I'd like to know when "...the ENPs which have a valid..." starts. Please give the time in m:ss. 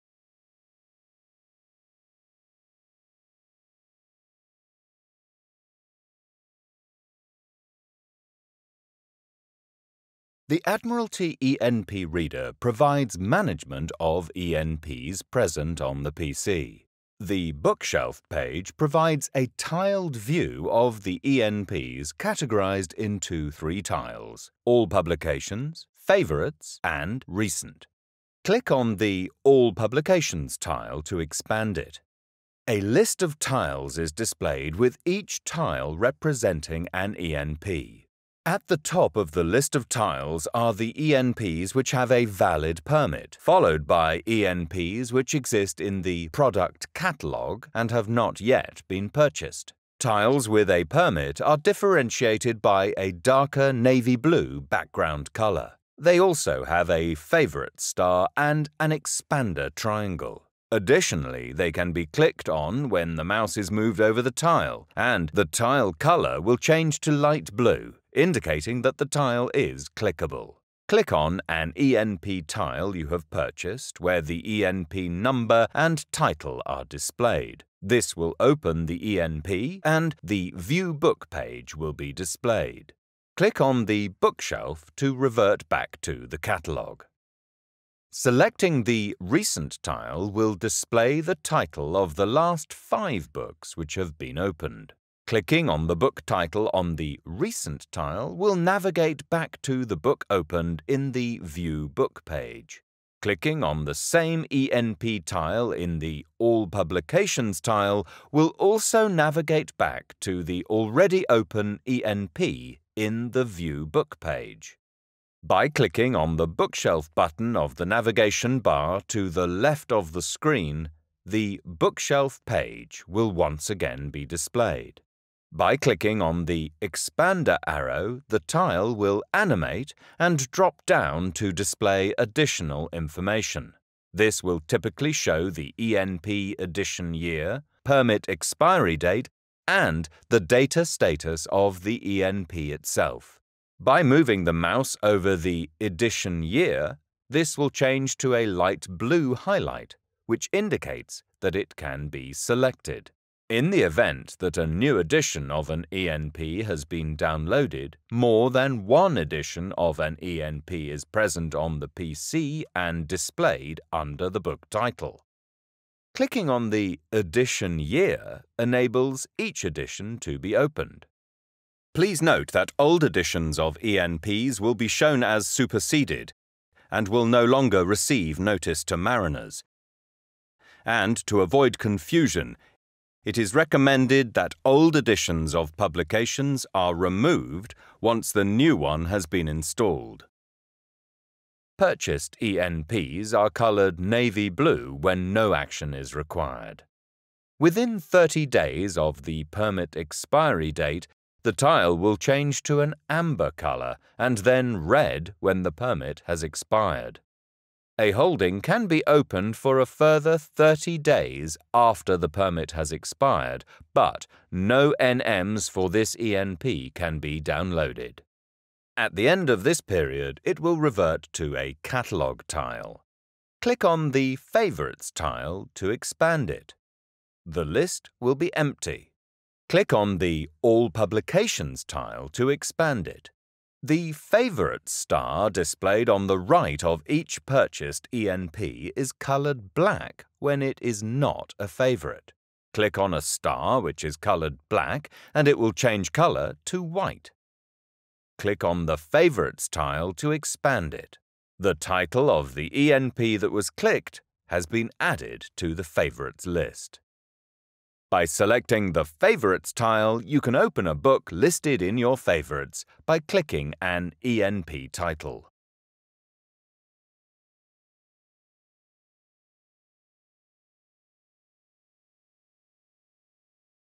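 0:40.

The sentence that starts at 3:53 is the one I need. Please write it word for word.
The favourite star displayed on the right of each purchased ENP is coloured black when it is not a favourite.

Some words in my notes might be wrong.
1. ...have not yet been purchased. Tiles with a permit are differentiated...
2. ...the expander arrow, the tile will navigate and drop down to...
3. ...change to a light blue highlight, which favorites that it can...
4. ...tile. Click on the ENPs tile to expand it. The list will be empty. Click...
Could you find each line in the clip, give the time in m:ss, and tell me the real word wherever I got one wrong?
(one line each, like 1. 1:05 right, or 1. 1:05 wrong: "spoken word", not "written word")
1. 0:47 right
2. 2:06 wrong: "animate", not "navigate"
3. 2:27 wrong: "indicates", not "favorites"
4. 3:42 wrong: "Favorites", not "ENPs".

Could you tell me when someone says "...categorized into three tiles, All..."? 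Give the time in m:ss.
0:22.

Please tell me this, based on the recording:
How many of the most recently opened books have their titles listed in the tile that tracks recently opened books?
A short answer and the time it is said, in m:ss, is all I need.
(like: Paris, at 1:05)
5, at 1:32.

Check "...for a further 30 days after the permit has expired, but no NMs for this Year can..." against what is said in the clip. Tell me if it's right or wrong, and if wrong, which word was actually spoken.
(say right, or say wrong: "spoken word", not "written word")
wrong: "ENP", not "Year".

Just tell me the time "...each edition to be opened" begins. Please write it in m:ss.
2:49.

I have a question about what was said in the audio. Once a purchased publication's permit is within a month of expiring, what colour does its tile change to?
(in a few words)
amber.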